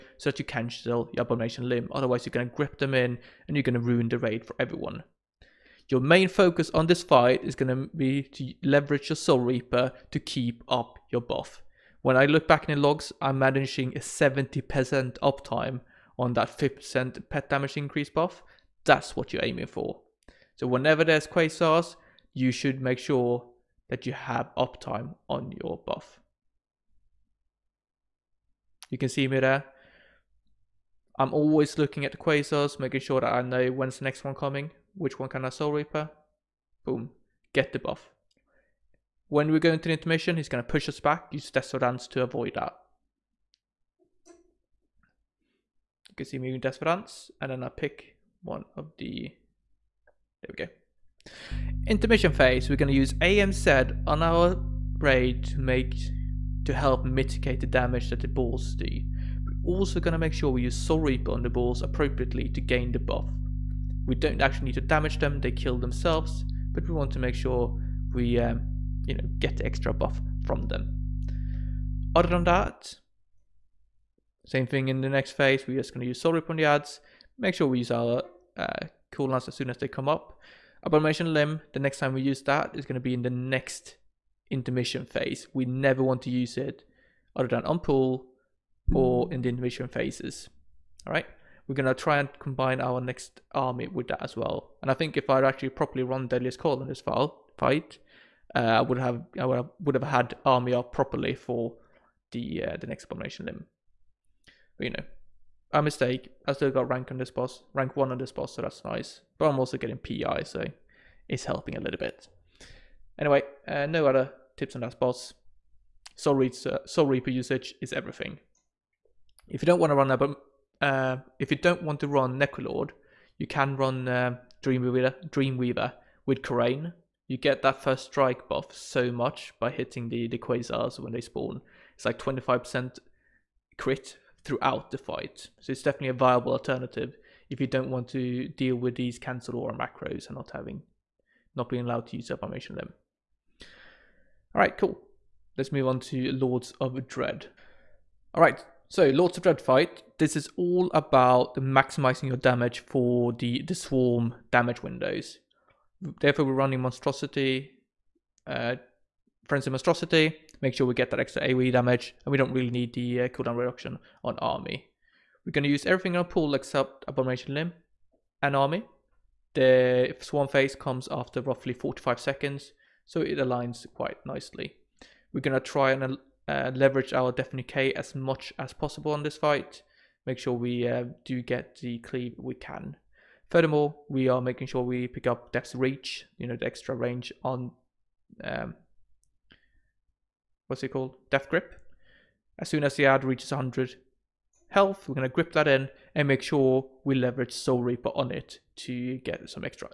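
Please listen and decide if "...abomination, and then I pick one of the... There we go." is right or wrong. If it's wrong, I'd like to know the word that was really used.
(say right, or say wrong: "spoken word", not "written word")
wrong: "desperation", not "abomination".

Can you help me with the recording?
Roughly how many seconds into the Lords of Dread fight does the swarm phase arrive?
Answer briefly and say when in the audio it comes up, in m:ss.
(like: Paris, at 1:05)
45 seconds, at 2:51.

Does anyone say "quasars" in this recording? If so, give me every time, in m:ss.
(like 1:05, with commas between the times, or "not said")
0:21, 0:32, 2:10.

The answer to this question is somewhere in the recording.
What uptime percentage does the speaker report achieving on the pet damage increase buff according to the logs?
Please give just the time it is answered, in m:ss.
0:13.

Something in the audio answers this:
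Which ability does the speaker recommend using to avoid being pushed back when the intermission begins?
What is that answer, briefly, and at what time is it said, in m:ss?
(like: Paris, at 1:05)
Desperation Dance, at 0:41.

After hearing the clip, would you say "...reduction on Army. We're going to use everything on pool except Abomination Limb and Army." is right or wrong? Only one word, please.
right.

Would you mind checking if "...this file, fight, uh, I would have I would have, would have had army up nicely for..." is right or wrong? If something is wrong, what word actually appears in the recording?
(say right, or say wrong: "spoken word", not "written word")
wrong: "properly", not "nicely".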